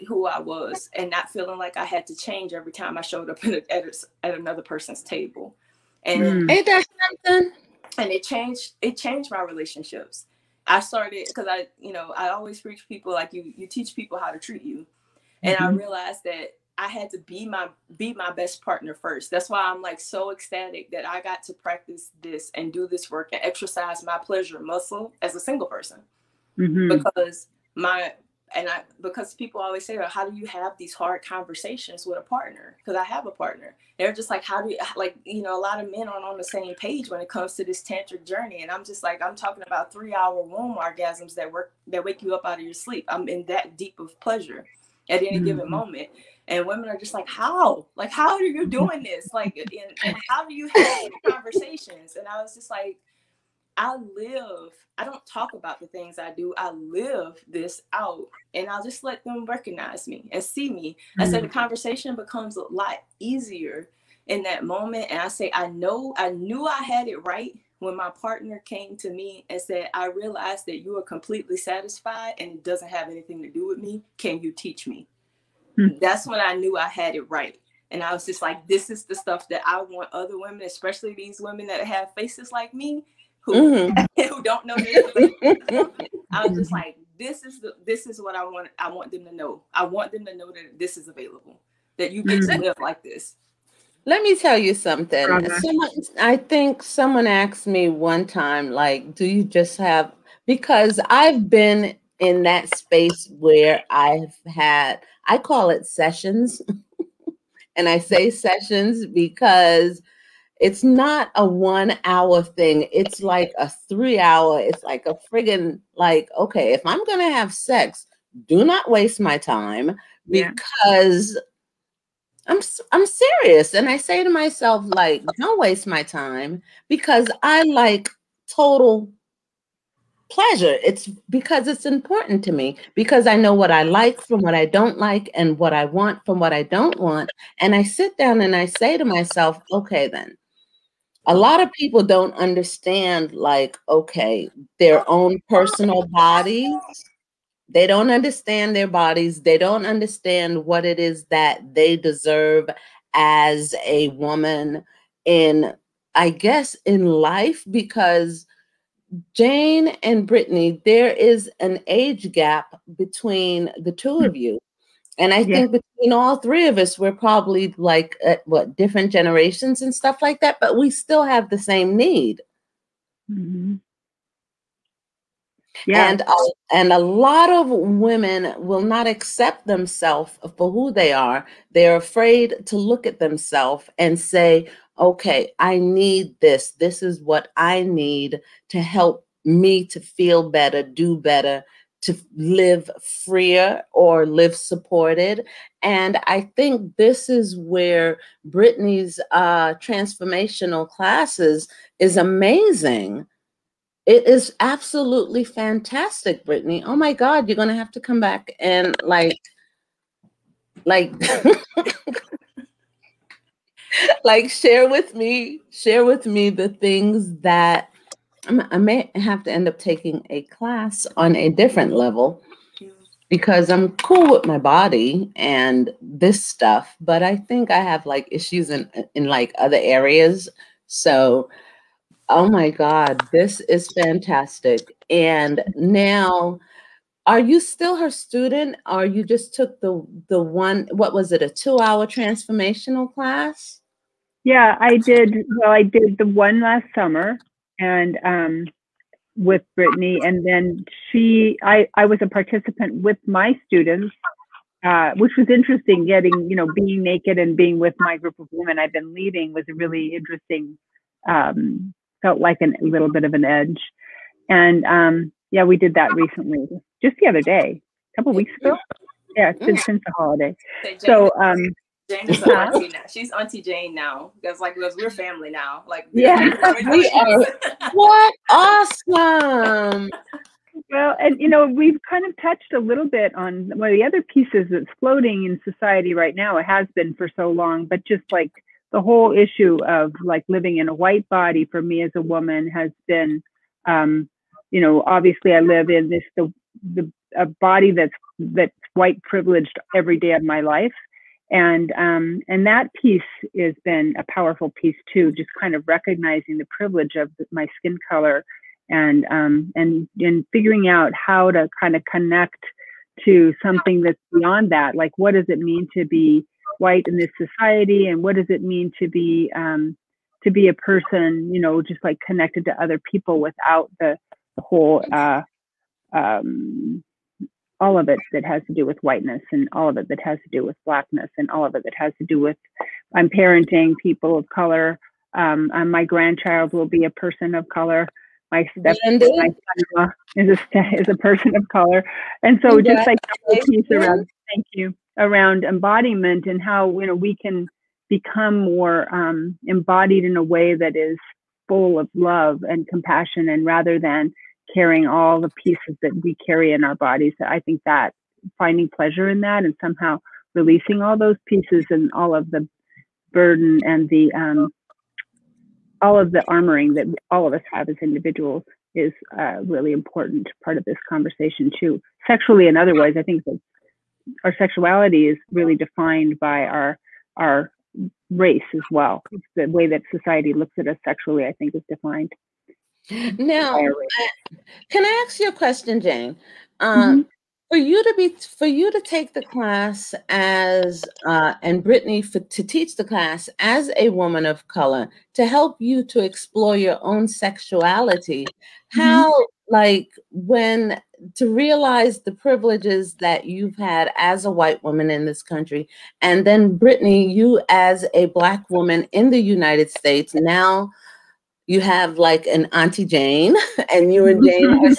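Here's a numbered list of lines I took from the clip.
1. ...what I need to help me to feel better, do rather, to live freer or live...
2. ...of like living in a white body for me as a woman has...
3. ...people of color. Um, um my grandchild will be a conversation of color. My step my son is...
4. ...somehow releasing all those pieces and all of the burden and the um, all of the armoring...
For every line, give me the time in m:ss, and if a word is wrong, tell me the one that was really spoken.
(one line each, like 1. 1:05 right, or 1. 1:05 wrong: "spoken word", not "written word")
1. 3:07 wrong: "better", not "rather"
2. 4:49 right
3. 5:34 wrong: "person", not "conversation"
4. 5:59 right.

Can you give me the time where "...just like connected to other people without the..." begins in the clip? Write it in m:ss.
5:21.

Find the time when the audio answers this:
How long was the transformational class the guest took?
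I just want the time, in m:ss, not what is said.
4:01.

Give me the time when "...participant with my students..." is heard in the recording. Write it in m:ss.
4:12.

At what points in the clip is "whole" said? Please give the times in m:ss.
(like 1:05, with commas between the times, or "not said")
4:49, 5:24.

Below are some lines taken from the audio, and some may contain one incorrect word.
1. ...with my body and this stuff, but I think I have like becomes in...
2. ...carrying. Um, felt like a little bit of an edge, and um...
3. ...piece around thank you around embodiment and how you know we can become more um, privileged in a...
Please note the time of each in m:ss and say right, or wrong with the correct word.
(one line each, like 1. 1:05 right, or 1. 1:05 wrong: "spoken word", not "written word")
1. 3:44 wrong: "issues", not "becomes"
2. 4:20 wrong: "interesting", not "carrying"
3. 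5:43 wrong: "embodied", not "privileged".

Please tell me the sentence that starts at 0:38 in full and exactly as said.
And I'm just like, I'm talking about three hour womb orgasms that work that wake you up out of your sleep.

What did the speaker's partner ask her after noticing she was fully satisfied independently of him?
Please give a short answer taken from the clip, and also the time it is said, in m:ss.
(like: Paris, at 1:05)
Can you teach me?, at 1:14.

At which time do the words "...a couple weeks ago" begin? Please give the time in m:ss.
4:28.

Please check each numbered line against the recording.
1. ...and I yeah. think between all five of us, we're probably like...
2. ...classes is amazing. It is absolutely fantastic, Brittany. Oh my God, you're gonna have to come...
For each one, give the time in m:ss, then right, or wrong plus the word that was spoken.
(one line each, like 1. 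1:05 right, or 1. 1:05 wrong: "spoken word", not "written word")
1. 2:45 wrong: "three", not "five"
2. 3:20 right.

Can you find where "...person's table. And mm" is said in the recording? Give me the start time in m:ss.
0:04.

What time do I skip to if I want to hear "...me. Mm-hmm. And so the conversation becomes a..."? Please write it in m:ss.
1:00.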